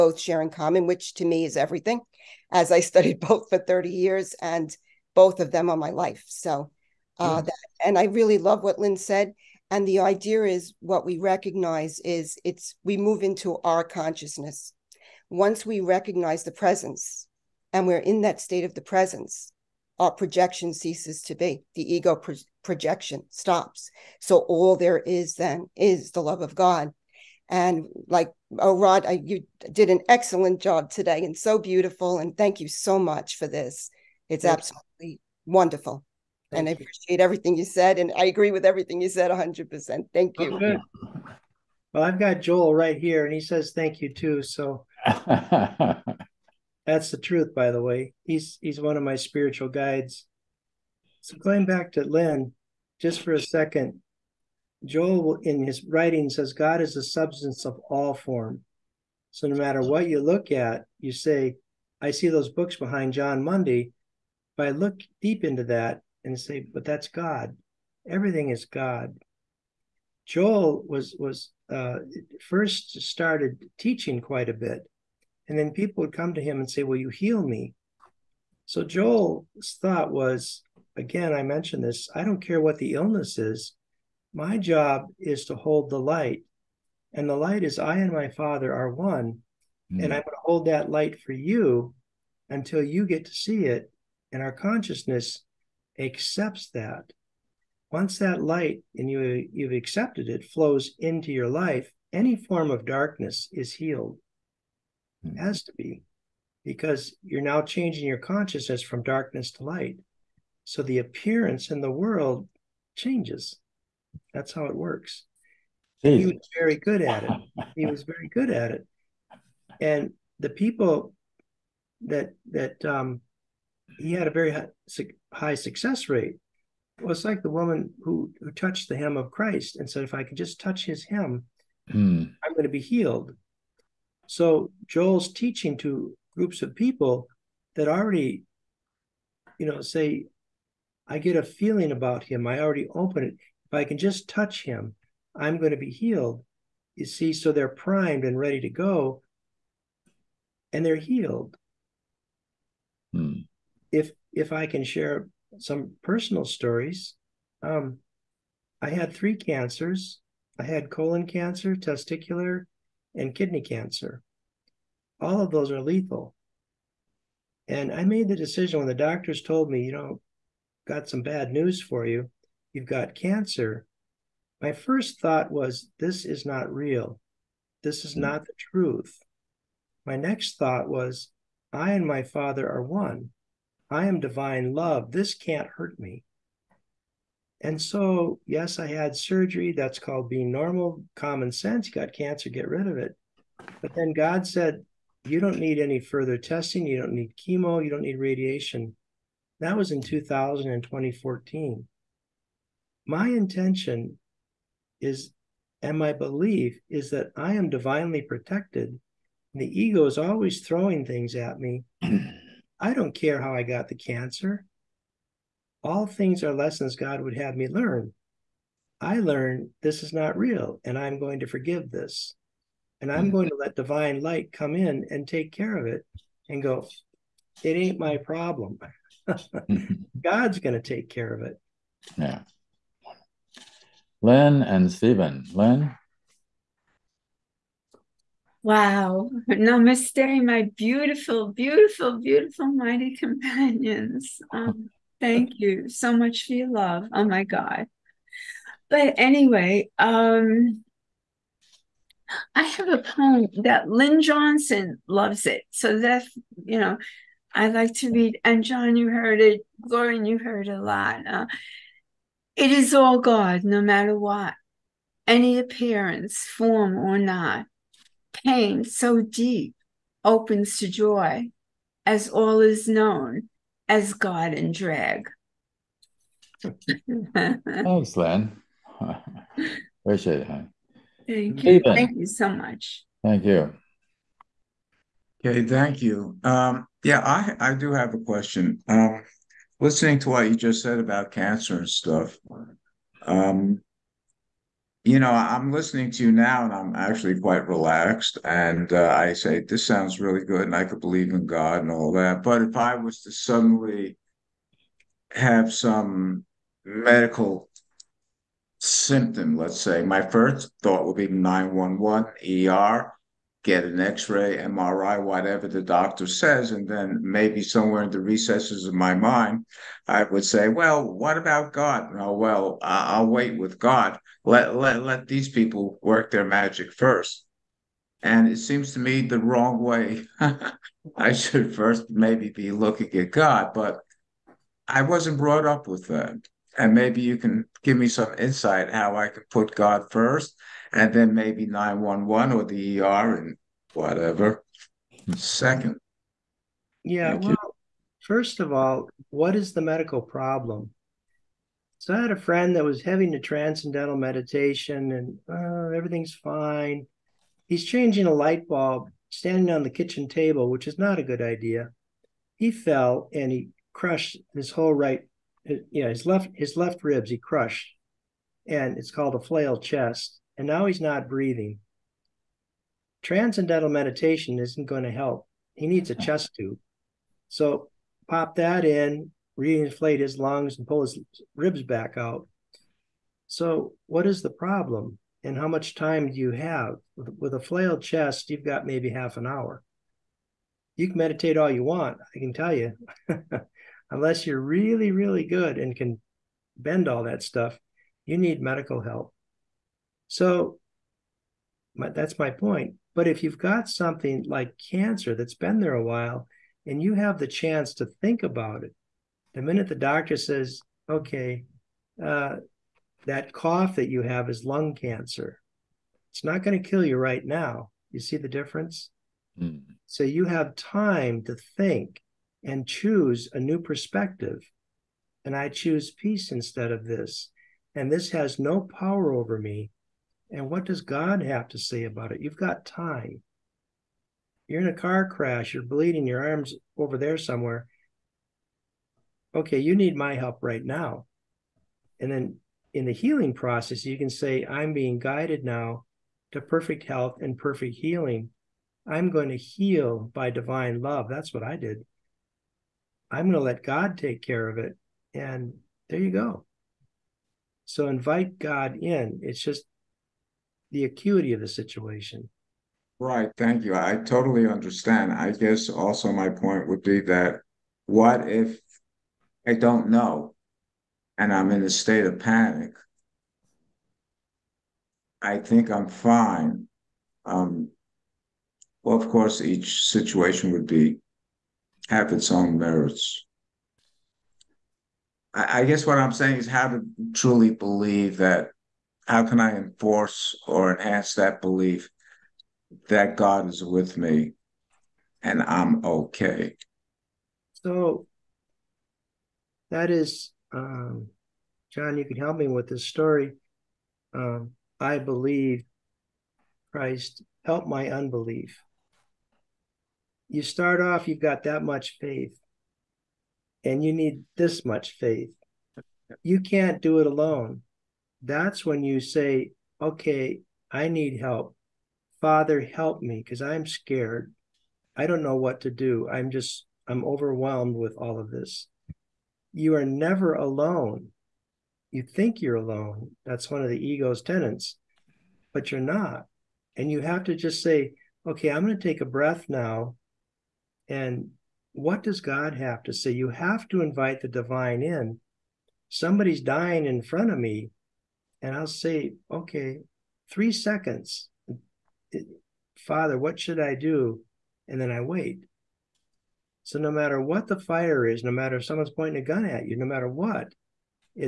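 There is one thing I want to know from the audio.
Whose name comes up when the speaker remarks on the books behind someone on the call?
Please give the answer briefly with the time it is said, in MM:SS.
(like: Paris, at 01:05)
Jon Mundy, at 01:03.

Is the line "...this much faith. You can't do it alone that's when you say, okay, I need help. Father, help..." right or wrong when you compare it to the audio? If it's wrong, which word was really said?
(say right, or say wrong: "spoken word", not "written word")
right.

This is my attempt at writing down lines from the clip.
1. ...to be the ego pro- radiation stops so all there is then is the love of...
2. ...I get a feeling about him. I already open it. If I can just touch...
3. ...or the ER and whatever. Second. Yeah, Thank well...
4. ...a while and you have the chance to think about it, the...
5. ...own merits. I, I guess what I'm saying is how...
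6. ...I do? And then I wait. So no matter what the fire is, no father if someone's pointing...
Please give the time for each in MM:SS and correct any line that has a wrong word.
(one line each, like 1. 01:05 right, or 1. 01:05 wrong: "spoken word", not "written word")
1. 00:21 wrong: "projection", not "radiation"
2. 02:21 right
3. 05:42 right
4. 06:45 right
5. 08:02 right
6. 09:13 wrong: "matter", not "father".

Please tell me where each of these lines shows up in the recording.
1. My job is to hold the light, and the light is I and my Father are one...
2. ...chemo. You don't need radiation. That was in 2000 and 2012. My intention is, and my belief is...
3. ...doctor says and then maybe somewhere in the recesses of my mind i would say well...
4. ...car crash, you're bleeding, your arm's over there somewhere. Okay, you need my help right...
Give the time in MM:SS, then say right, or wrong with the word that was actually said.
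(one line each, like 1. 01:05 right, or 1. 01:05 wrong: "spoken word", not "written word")
1. 01:24 right
2. 03:17 wrong: "2014", not "2012"
3. 05:15 right
4. 07:14 right.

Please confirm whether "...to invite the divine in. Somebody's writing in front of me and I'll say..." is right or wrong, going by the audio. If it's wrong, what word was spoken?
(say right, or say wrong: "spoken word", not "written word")
wrong: "dying", not "writing".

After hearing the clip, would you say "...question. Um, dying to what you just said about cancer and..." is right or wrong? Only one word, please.
wrong.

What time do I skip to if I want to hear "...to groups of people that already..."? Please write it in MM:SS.
02:15.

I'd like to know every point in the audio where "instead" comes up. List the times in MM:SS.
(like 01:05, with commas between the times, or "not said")
07:06.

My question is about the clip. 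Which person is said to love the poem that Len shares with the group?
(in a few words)
Lynn Johnson.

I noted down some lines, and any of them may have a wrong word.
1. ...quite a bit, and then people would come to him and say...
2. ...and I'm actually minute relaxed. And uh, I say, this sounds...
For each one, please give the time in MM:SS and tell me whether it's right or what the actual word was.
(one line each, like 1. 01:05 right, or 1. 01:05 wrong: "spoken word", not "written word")
1. 01:14 right
2. 04:56 wrong: "quite", not "minute".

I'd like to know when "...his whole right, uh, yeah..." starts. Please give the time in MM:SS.
06:04.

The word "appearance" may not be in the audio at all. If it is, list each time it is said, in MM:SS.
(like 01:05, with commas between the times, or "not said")
01:50, 04:25.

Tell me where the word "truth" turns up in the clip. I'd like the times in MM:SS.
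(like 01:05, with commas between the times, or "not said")
00:47, 02:58.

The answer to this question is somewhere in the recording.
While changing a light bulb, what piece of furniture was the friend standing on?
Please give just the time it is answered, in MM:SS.
05:59.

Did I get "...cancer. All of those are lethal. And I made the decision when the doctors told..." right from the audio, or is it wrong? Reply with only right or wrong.
right.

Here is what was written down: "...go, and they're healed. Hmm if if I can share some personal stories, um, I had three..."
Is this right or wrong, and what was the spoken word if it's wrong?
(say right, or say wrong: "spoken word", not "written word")
right.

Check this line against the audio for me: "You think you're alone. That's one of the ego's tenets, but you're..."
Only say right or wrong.
right.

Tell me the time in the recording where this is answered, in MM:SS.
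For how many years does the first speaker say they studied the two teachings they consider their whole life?
00:03.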